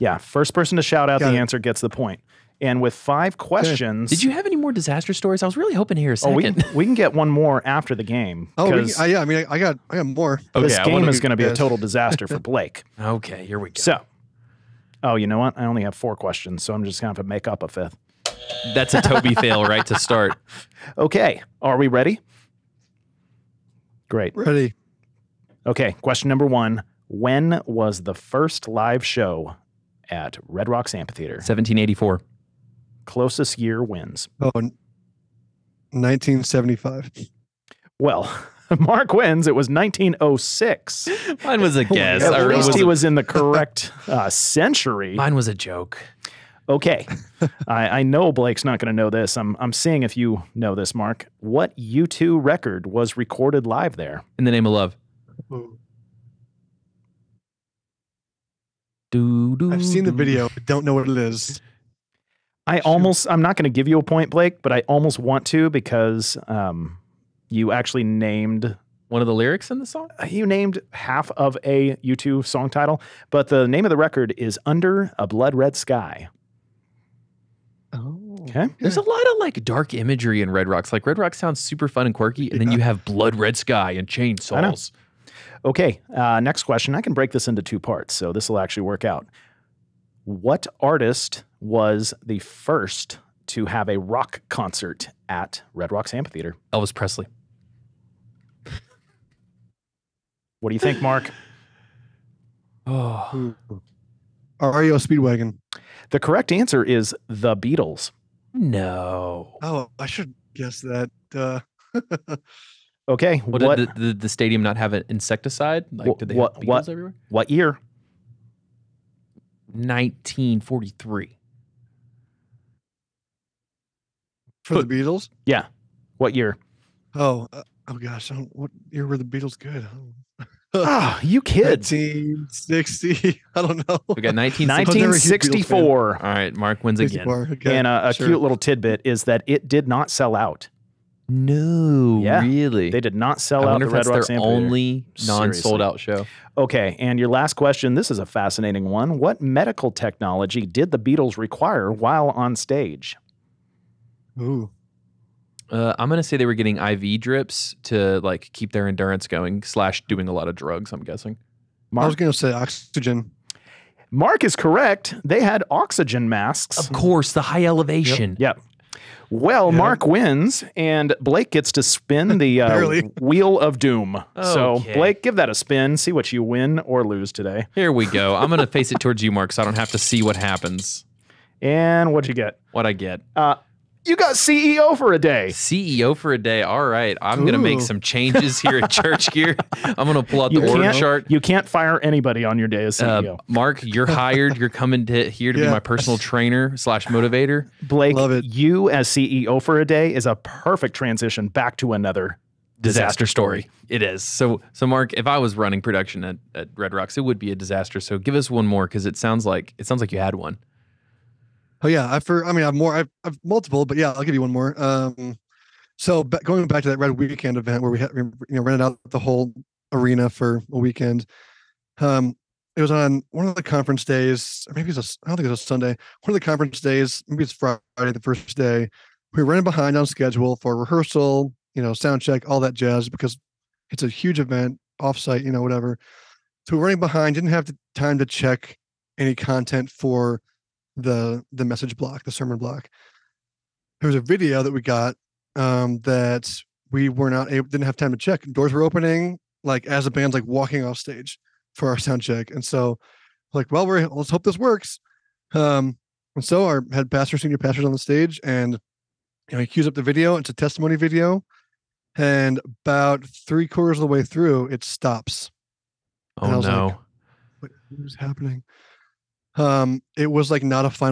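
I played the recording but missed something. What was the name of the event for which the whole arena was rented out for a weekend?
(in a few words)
Red Weekend.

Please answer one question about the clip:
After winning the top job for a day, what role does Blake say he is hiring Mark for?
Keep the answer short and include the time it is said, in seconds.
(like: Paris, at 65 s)
Personal trainer, at 195 s.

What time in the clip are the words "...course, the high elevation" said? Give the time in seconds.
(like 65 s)
166 s.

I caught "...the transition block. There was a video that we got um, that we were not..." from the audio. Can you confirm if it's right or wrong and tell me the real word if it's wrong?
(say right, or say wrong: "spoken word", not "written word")
wrong: "sermon", not "transition".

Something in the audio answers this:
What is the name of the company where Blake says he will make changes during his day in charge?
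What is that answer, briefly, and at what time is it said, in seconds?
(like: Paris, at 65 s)
Church Gear, at 188 s.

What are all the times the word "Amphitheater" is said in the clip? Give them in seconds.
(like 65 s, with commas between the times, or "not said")
30 s, 96 s.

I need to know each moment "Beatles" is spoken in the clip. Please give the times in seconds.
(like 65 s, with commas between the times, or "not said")
107 s, 124 s, 129 s, 150 s.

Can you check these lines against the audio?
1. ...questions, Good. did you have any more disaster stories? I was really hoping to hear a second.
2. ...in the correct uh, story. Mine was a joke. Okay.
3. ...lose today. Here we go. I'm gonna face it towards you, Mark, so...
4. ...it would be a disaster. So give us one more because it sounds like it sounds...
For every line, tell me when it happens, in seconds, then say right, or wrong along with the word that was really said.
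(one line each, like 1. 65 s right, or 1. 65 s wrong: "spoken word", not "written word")
1. 3 s right
2. 43 s wrong: "century", not "story"
3. 177 s right
4. 207 s right.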